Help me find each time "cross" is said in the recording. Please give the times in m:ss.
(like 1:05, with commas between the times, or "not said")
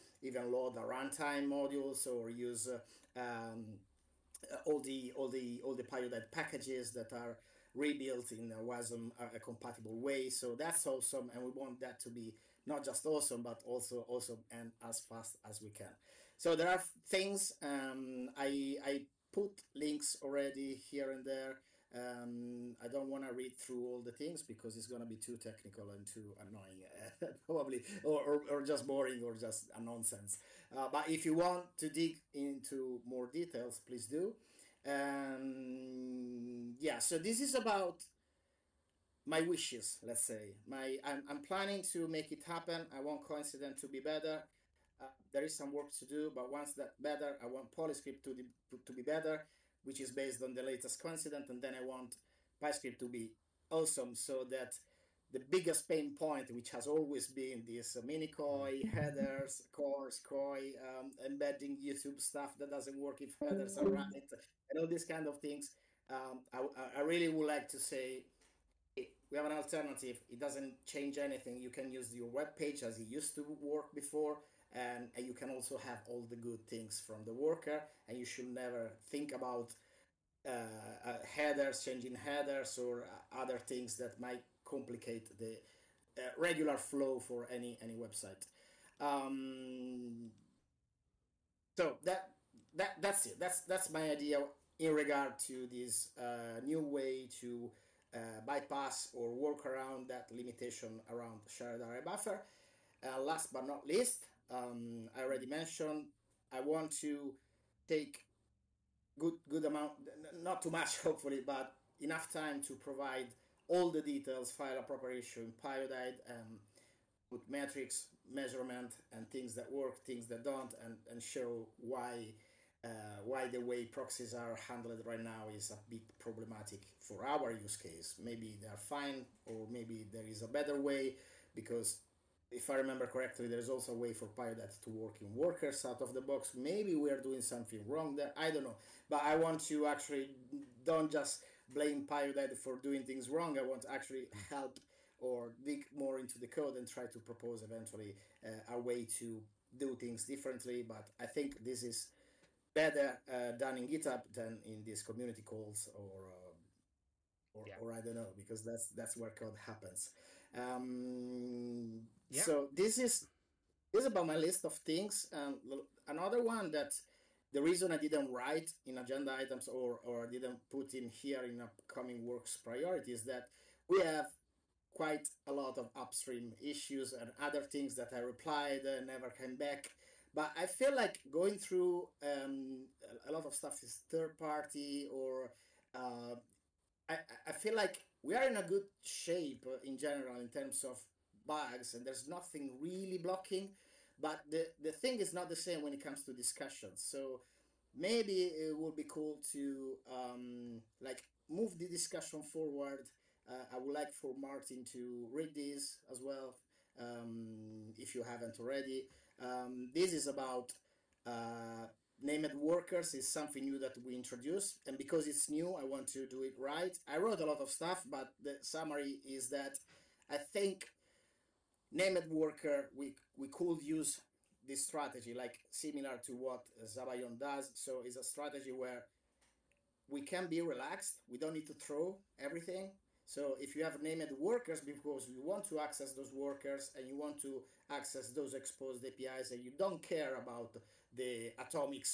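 not said.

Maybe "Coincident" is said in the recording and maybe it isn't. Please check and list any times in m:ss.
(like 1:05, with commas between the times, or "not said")
0:43, 0:51.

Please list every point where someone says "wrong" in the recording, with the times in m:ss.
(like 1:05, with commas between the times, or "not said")
2:17, 2:23.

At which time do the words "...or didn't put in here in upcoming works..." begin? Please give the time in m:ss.
2:50.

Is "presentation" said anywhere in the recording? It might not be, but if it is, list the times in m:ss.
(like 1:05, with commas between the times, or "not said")
not said.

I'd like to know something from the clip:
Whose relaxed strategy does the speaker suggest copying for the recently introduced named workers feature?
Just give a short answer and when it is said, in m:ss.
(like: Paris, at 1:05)
sabayon, at 3:46.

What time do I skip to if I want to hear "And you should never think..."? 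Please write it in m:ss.
1:18.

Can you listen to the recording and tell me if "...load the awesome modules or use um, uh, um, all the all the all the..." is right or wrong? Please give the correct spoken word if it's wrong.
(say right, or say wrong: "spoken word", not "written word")
wrong: "runtime", not "awesome".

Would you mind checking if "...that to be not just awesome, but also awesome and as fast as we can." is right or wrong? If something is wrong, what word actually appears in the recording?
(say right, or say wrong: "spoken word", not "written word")
right.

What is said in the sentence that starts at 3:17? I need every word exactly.
So maybe it would be cool to um, like move the discussion forward.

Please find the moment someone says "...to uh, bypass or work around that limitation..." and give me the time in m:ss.
1:37.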